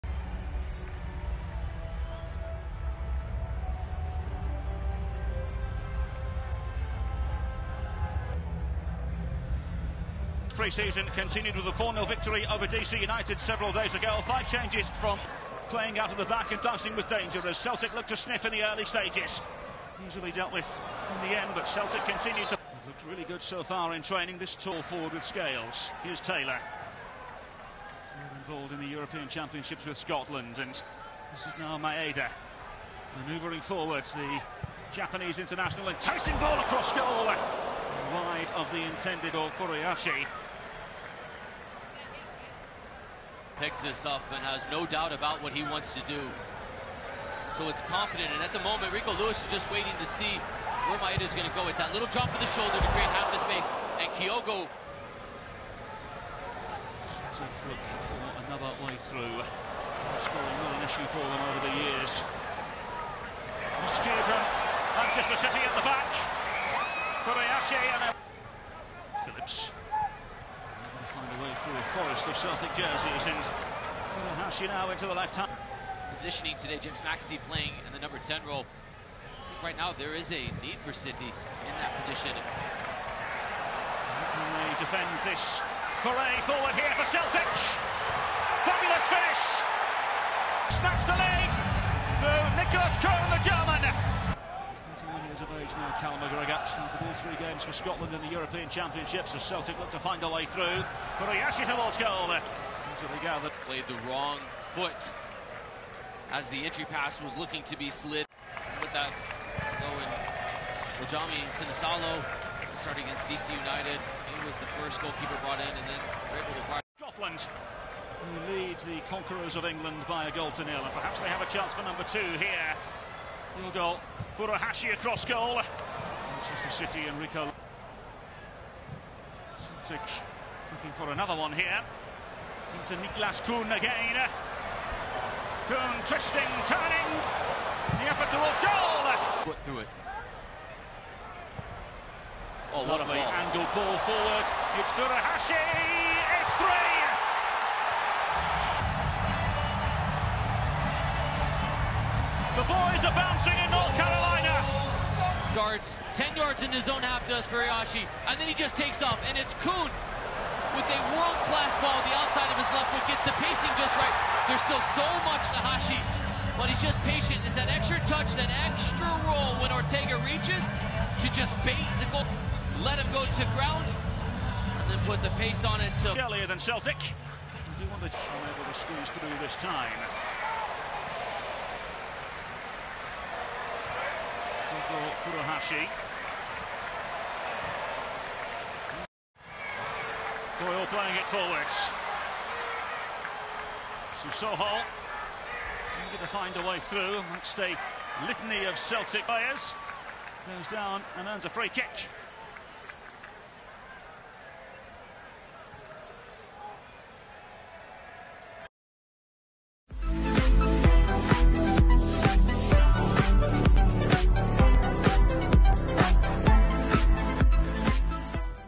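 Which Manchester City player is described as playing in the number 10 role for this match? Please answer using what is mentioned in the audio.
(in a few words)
James McAtee.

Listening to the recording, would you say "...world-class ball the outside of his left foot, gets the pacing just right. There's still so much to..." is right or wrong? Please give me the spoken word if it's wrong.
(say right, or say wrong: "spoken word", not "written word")
right.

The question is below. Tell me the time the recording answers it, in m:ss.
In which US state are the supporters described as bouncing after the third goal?
2:33.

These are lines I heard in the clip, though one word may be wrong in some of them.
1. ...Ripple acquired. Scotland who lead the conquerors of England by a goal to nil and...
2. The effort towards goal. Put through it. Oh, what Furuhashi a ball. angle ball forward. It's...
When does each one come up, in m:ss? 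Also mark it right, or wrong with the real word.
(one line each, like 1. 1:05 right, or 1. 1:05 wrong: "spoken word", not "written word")
1. 1:56 right
2. 2:18 wrong: "Lovely", not "Furuhashi".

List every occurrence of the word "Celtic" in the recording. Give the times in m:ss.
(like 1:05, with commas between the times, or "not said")
0:17, 0:21, 1:12, 1:27, 1:39, 2:09, 2:56, 3:18.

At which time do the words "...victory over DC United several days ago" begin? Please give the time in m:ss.
0:12.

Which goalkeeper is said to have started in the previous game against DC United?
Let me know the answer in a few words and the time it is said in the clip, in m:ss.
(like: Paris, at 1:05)
Viljami Sinisalo, at 1:51.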